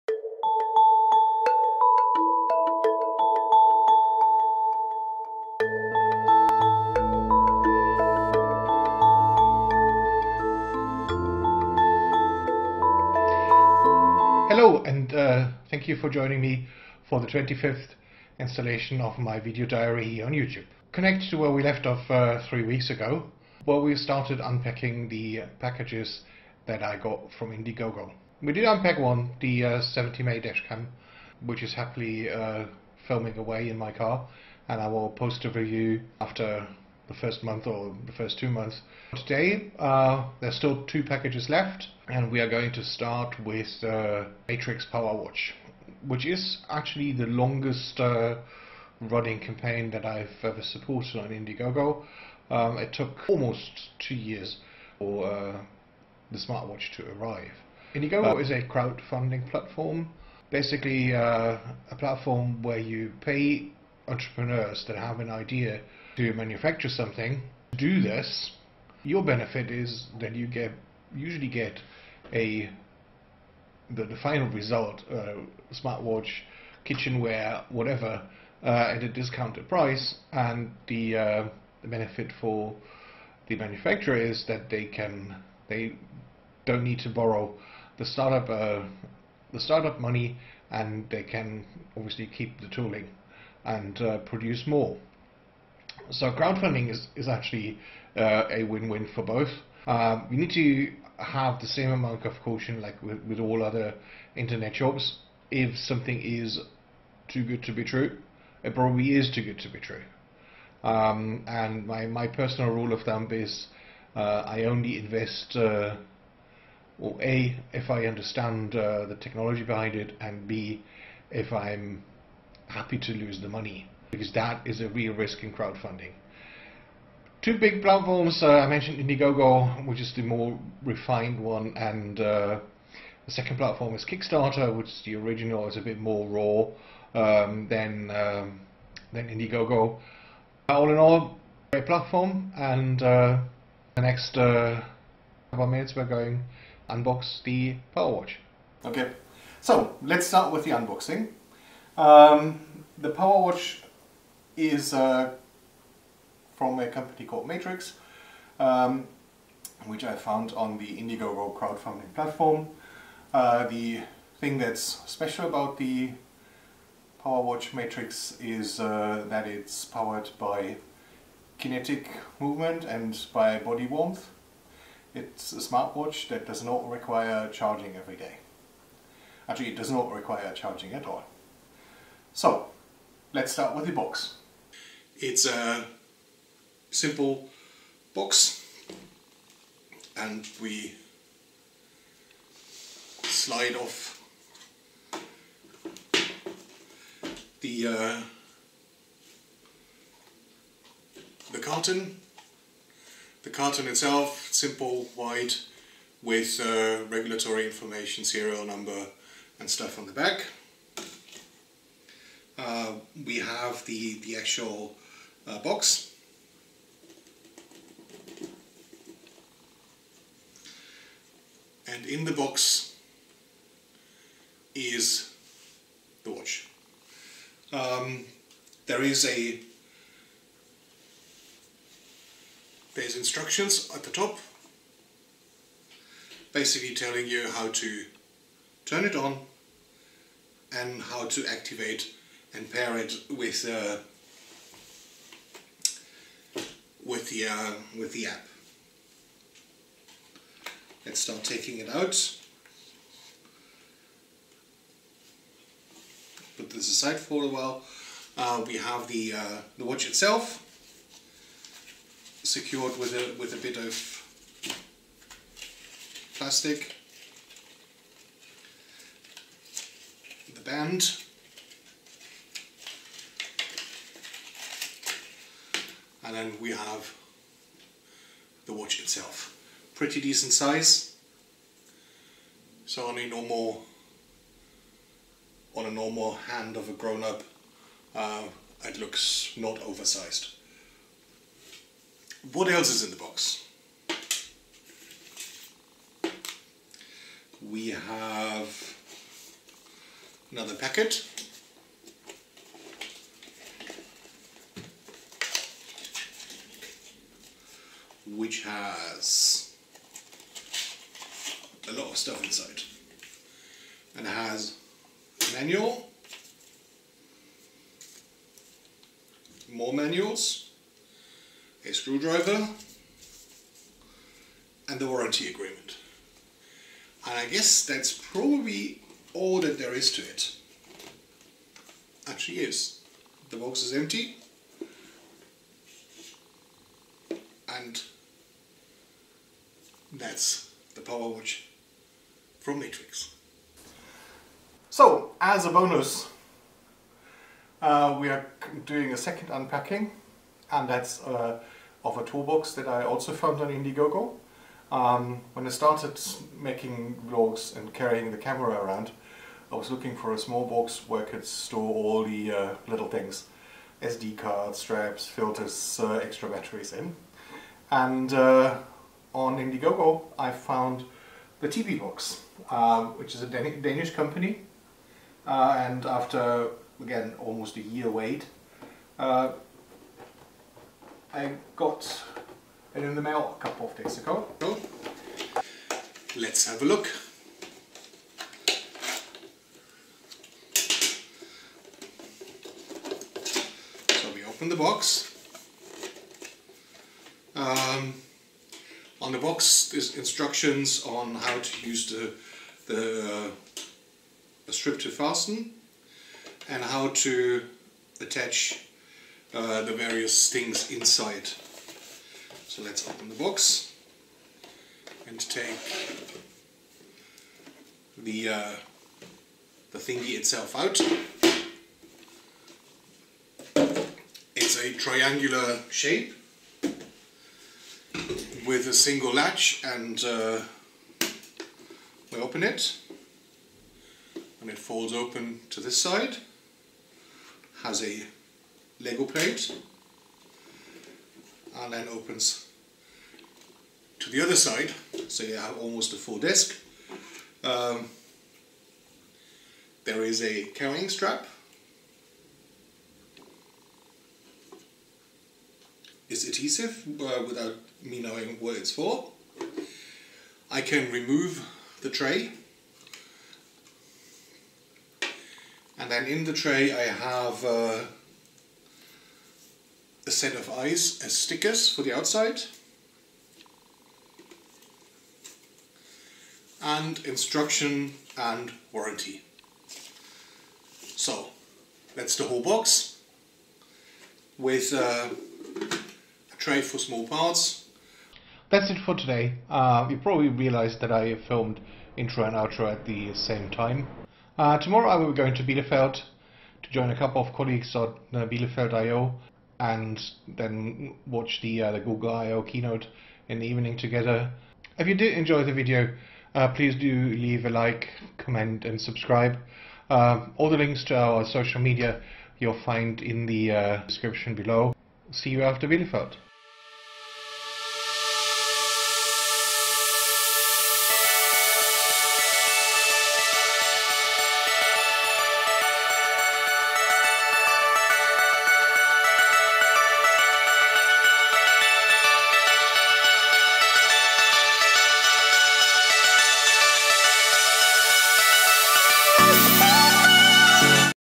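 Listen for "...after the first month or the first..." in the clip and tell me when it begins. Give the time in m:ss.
0:36.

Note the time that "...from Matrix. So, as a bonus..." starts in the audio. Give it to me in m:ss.
5:42.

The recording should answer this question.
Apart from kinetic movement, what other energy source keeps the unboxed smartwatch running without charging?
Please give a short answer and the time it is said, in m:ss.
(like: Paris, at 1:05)
body warmth, at 2:53.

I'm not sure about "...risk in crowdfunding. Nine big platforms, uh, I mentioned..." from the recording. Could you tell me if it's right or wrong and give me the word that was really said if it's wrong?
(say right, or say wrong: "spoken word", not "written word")
wrong: "Two", not "Nine".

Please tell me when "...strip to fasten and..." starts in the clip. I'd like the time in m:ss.
6:44.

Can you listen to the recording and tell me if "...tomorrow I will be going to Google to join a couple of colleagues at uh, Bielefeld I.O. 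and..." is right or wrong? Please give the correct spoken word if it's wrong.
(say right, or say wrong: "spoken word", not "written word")
wrong: "Bielefeld", not "Google".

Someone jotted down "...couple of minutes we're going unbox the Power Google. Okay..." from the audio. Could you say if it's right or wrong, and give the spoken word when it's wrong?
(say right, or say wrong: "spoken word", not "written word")
wrong: "Watch", not "Google".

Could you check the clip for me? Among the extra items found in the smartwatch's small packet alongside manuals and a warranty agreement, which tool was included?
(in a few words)
screwdriver.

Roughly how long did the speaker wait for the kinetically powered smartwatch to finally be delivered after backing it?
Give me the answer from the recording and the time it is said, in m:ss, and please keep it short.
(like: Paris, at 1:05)
almost two years, at 0:53.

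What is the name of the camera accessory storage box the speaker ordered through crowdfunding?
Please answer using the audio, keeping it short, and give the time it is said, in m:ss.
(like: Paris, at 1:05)
Teebee Box, at 6:11.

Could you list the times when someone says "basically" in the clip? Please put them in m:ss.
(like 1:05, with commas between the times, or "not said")
1:00, 3:56.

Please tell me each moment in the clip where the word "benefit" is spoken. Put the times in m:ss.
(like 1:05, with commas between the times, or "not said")
1:09, 1:21.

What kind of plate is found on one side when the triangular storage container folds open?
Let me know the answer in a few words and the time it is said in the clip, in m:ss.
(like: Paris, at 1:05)
Lego plate, at 7:19.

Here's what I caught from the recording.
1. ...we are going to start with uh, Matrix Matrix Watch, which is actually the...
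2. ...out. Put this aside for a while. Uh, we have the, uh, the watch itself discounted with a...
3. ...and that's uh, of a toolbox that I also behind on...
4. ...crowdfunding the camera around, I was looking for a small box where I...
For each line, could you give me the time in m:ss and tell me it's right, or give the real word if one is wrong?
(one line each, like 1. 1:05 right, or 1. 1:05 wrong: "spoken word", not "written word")
1. 0:42 wrong: "Power", not "Matrix"
2. 4:11 wrong: "secured", not "discounted"
3. 5:50 wrong: "found", not "behind"
4. 5:57 wrong: "carrying", not "crowdfunding".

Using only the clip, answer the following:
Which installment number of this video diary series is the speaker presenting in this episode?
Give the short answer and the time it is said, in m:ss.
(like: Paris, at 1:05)
25th, at 0:17.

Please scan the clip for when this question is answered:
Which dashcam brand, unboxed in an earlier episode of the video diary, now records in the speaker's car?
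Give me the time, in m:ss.
0:29.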